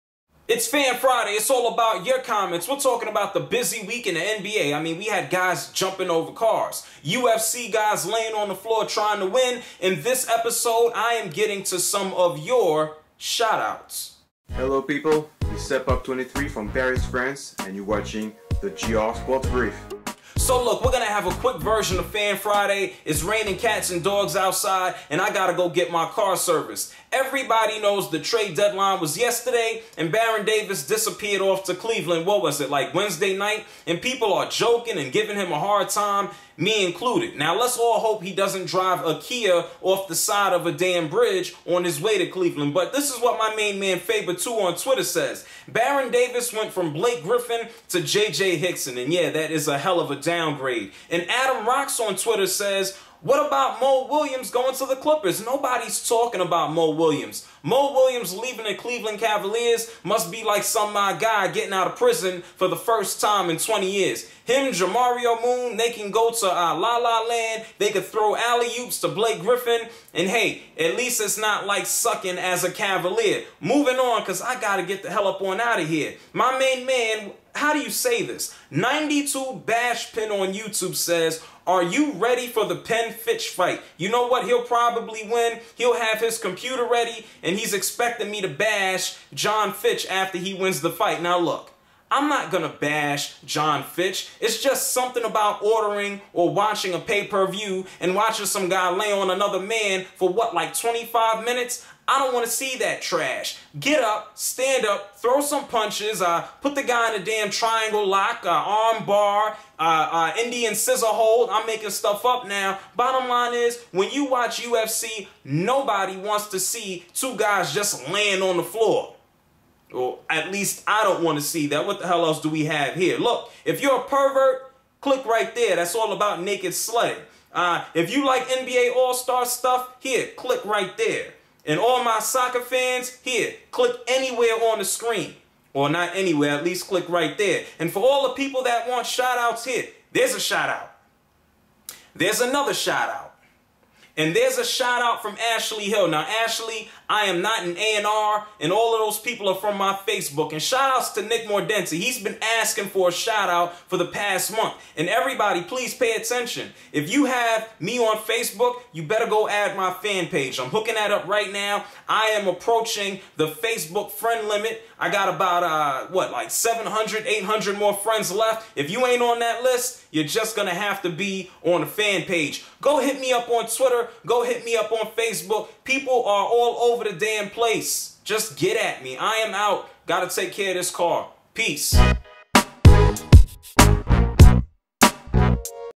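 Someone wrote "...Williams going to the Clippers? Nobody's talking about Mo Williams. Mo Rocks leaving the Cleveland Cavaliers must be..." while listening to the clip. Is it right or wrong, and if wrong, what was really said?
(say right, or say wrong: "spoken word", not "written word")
wrong: "Williams", not "Rocks".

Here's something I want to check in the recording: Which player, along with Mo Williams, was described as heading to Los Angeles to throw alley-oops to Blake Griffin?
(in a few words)
Jamario Moon.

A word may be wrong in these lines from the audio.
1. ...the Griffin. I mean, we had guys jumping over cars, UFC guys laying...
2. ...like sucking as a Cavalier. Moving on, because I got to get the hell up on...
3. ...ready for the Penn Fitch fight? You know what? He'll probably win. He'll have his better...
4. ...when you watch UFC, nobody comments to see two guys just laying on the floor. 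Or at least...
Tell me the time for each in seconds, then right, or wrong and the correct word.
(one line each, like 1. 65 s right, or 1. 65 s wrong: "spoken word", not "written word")
1. 4 s wrong: "NBA", not "Griffin"
2. 71 s right
3. 82 s wrong: "computer", not "better"
4. 113 s wrong: "wants", not "comments".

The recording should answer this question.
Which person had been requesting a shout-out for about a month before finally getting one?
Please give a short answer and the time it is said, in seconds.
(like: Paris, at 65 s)
Nick Mordenti, at 151 s.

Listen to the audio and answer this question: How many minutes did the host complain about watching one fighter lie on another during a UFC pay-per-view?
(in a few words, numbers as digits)
25.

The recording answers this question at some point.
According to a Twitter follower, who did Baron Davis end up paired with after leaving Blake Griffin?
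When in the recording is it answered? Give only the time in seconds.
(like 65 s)
48 s.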